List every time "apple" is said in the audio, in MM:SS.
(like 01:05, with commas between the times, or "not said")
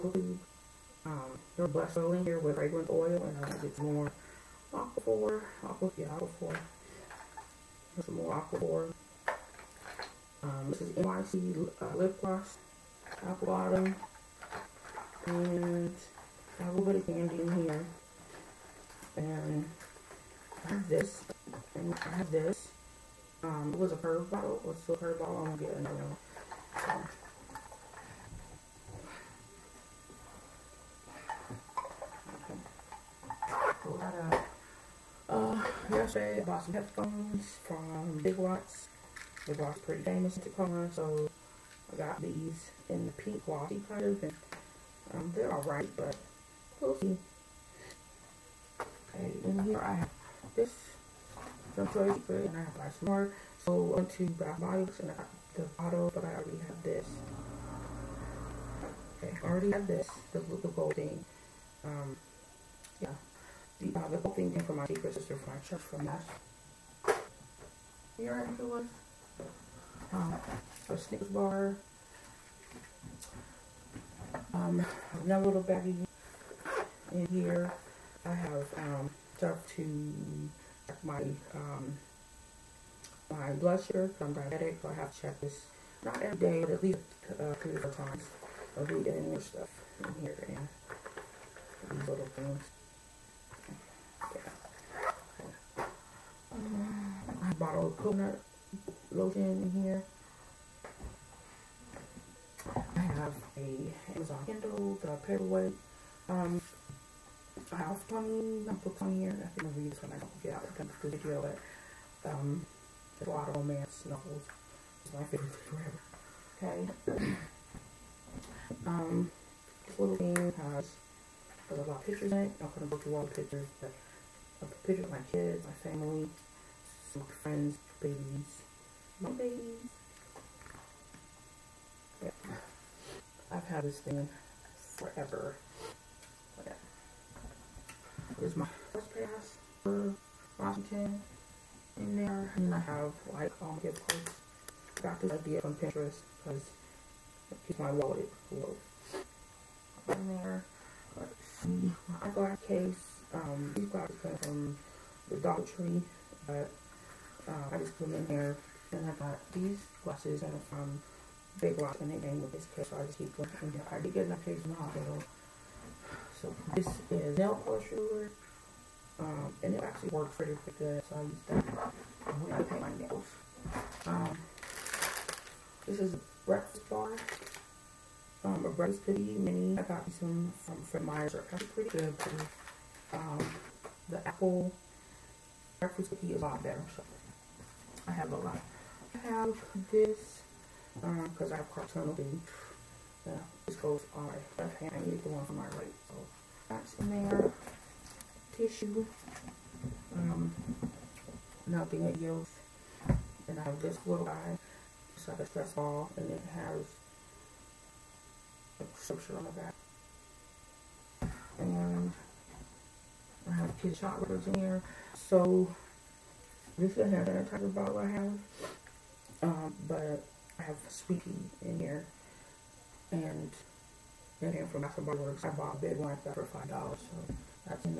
00:13, 03:04.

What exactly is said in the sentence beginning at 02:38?
Then I got these glasses that are from Big Lots, and they came with this case, so I just keep them.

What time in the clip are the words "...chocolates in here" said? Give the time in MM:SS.
03:33.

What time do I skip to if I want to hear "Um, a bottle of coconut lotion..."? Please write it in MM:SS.
01:36.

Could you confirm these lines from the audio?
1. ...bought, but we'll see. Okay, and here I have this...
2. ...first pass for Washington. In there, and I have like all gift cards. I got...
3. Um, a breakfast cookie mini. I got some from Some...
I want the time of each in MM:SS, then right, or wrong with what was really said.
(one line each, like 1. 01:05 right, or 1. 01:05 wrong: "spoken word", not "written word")
1. 00:45 wrong: "alright", not "bought"
2. 02:18 right
3. 02:58 wrong: "Fred", not "Some".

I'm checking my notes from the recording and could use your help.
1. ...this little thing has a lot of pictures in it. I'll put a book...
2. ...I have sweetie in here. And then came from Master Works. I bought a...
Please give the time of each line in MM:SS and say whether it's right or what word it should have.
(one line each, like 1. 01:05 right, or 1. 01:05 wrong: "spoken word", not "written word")
1. 01:59 right
2. 03:40 right.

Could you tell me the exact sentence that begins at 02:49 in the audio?
Um, and it actually works pretty, pretty good, so I use that when I paint my nails.